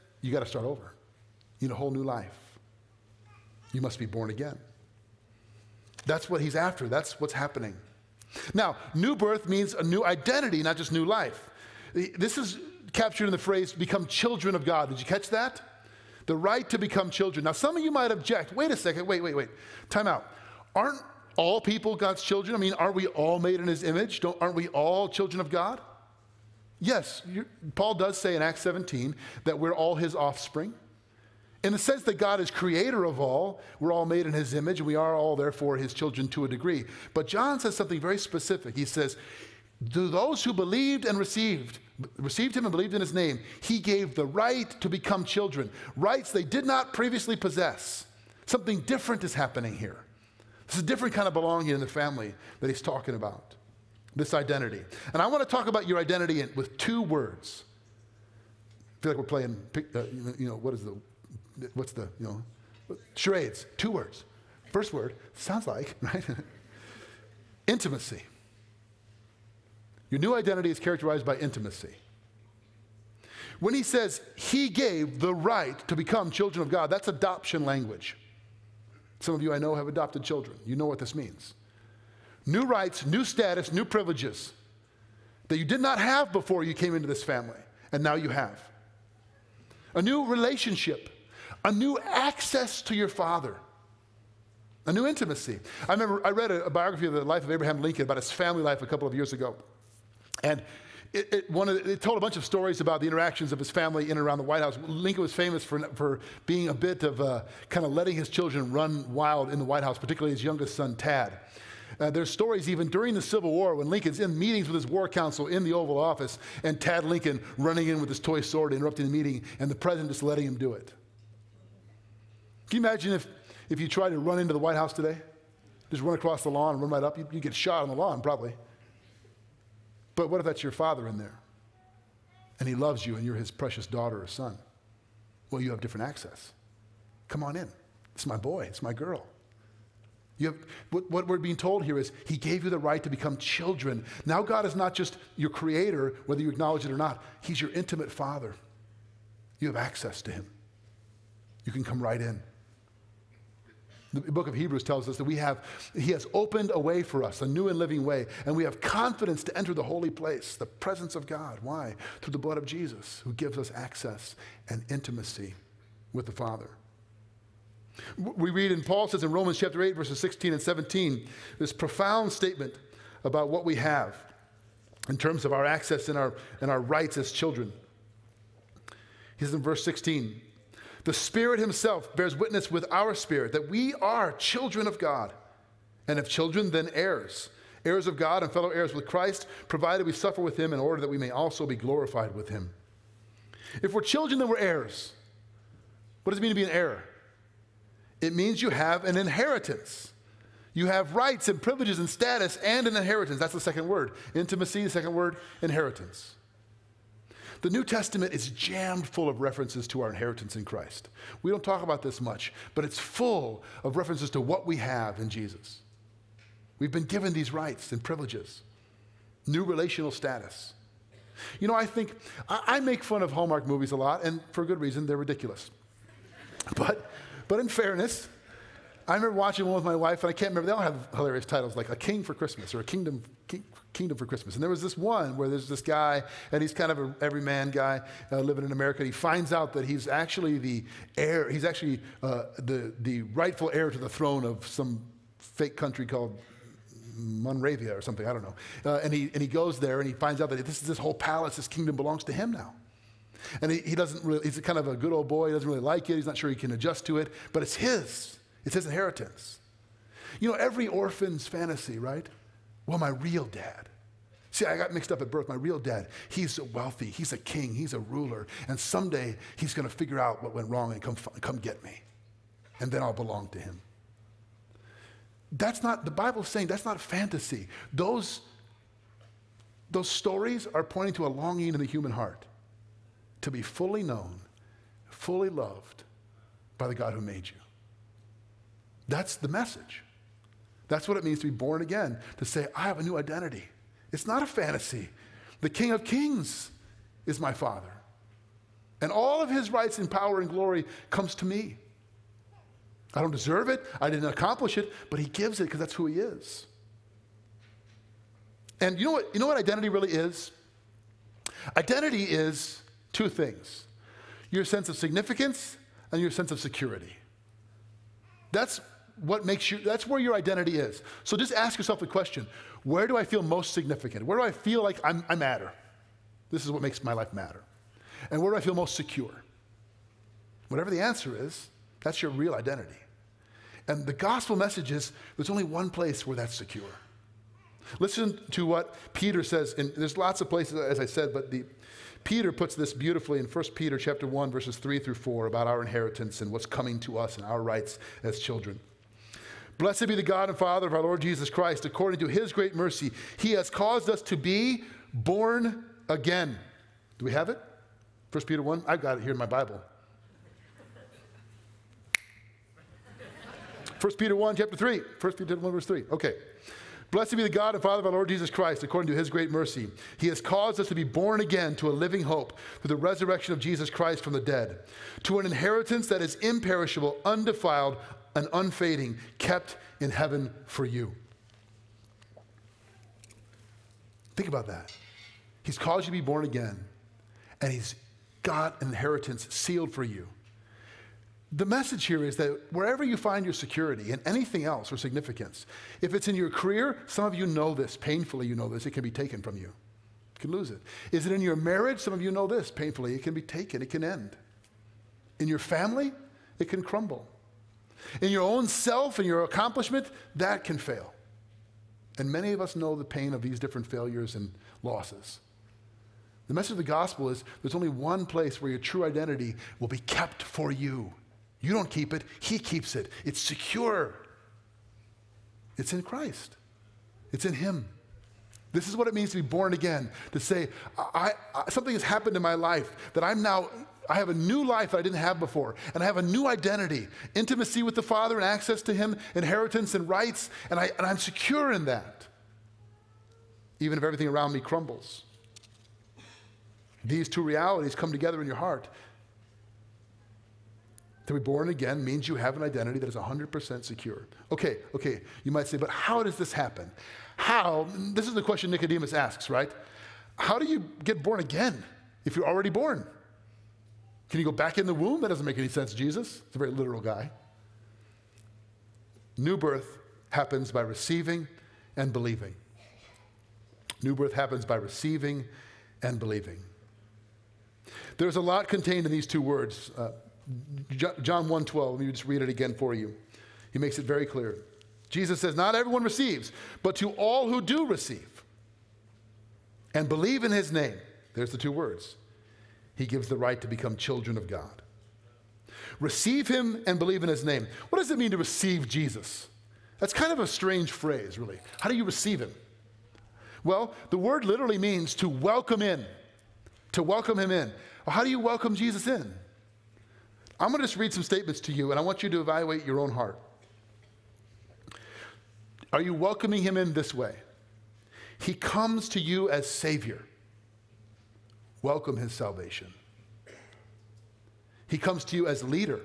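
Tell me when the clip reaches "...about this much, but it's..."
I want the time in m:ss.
3:31.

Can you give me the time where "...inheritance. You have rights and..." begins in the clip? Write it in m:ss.
3:19.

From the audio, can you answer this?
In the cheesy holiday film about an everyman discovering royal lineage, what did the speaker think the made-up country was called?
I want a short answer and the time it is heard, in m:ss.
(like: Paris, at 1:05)
Monravia, at 4:07.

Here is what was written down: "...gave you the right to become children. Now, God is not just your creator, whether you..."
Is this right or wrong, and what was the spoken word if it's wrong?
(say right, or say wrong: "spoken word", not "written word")
right.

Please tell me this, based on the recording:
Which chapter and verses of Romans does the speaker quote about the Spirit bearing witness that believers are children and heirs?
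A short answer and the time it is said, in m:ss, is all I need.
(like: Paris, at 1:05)
Romans 8:16-17, at 2:49.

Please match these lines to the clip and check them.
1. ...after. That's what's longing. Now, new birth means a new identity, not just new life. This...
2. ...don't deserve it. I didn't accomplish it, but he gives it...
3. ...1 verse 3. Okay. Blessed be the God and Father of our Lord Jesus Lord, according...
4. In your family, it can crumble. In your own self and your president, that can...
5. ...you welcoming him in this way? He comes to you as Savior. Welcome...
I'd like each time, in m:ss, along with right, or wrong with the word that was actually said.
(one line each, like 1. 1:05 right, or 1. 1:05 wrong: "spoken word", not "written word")
1. 0:06 wrong: "happening", not "longing"
2. 5:03 right
3. 6:05 wrong: "Christ", not "Lord"
4. 6:45 wrong: "accomplishment", not "president"
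5. 8:36 right.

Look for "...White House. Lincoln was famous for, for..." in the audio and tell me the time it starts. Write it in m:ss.
1:44.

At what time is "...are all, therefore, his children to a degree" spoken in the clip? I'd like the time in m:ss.
0:34.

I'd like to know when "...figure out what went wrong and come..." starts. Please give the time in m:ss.
4:29.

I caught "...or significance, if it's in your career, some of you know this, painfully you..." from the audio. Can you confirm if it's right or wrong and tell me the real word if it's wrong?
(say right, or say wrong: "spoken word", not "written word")
right.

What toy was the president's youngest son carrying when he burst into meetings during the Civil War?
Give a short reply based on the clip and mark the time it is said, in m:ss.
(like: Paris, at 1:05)
toy sword, at 1:58.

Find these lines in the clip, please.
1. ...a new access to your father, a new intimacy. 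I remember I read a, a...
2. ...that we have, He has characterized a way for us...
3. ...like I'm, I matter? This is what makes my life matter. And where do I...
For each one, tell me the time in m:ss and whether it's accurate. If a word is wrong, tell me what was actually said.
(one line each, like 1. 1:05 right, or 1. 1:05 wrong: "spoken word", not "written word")
1. 1:31 right
2. 2:35 wrong: "opened", not "characterized"
3. 5:24 right.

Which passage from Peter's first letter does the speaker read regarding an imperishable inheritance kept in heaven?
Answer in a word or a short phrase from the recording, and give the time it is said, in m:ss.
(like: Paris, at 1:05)
1 Peter 1:3-4, at 5:43.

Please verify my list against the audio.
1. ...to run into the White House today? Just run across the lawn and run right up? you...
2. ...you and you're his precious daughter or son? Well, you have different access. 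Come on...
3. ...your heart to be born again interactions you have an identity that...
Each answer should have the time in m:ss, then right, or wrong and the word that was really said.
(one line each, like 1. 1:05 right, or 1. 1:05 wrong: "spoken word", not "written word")
1. 2:04 right
2. 2:13 right
3. 7:28 wrong: "means", not "interactions".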